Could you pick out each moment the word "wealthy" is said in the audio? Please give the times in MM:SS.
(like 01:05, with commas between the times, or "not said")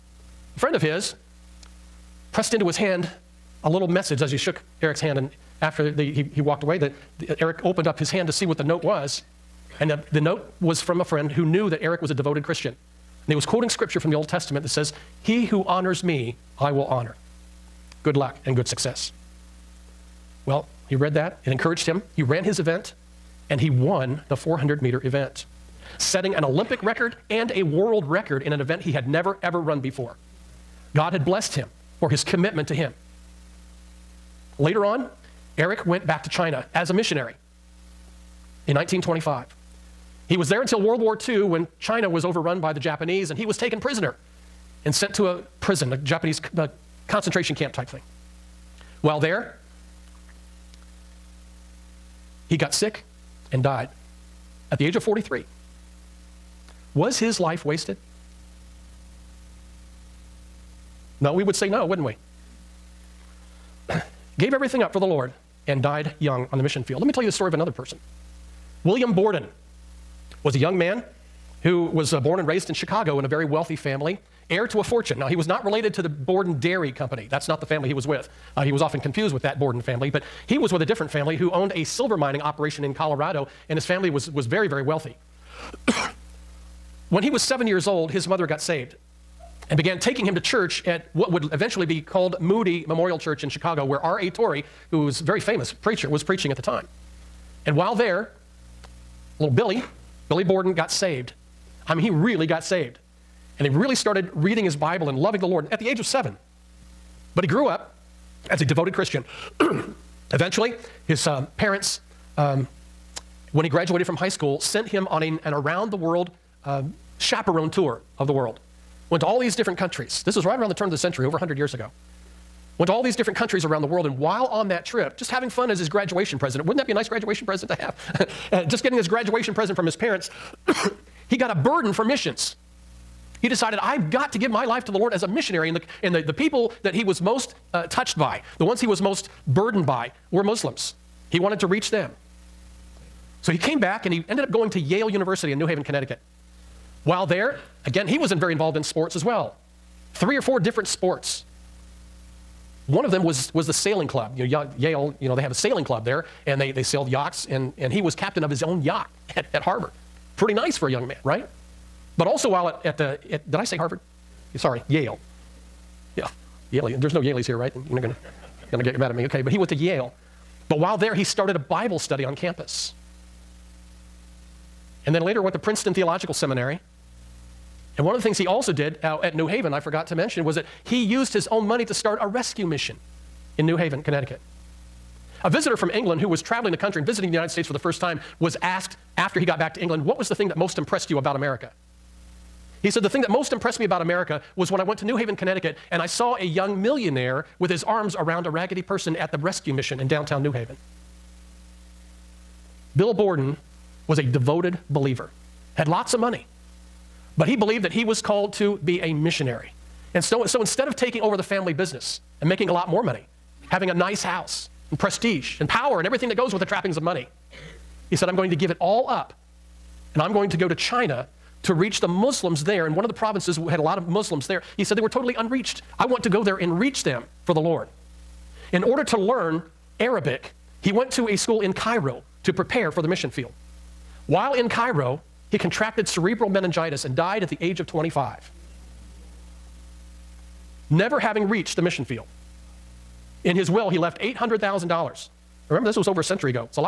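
01:13, 01:24.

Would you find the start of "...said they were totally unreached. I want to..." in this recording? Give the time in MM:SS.
03:44.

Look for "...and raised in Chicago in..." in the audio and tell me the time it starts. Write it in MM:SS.
01:12.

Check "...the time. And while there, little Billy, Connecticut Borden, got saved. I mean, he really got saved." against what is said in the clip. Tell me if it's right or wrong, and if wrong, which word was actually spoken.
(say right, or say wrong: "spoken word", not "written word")
wrong: "Billy", not "Connecticut".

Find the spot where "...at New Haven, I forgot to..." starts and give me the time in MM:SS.
02:59.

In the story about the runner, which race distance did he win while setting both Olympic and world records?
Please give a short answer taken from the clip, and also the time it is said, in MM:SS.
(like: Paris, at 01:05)
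400 meter, at 00:24.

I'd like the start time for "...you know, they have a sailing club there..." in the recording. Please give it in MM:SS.
02:35.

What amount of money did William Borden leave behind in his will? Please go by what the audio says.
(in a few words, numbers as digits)
$800,000.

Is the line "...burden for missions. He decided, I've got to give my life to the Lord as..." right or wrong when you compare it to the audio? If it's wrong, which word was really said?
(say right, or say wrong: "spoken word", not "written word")
right.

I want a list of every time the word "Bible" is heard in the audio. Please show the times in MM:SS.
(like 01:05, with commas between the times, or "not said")
01:44, 02:51.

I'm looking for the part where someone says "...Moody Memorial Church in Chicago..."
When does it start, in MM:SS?
01:32.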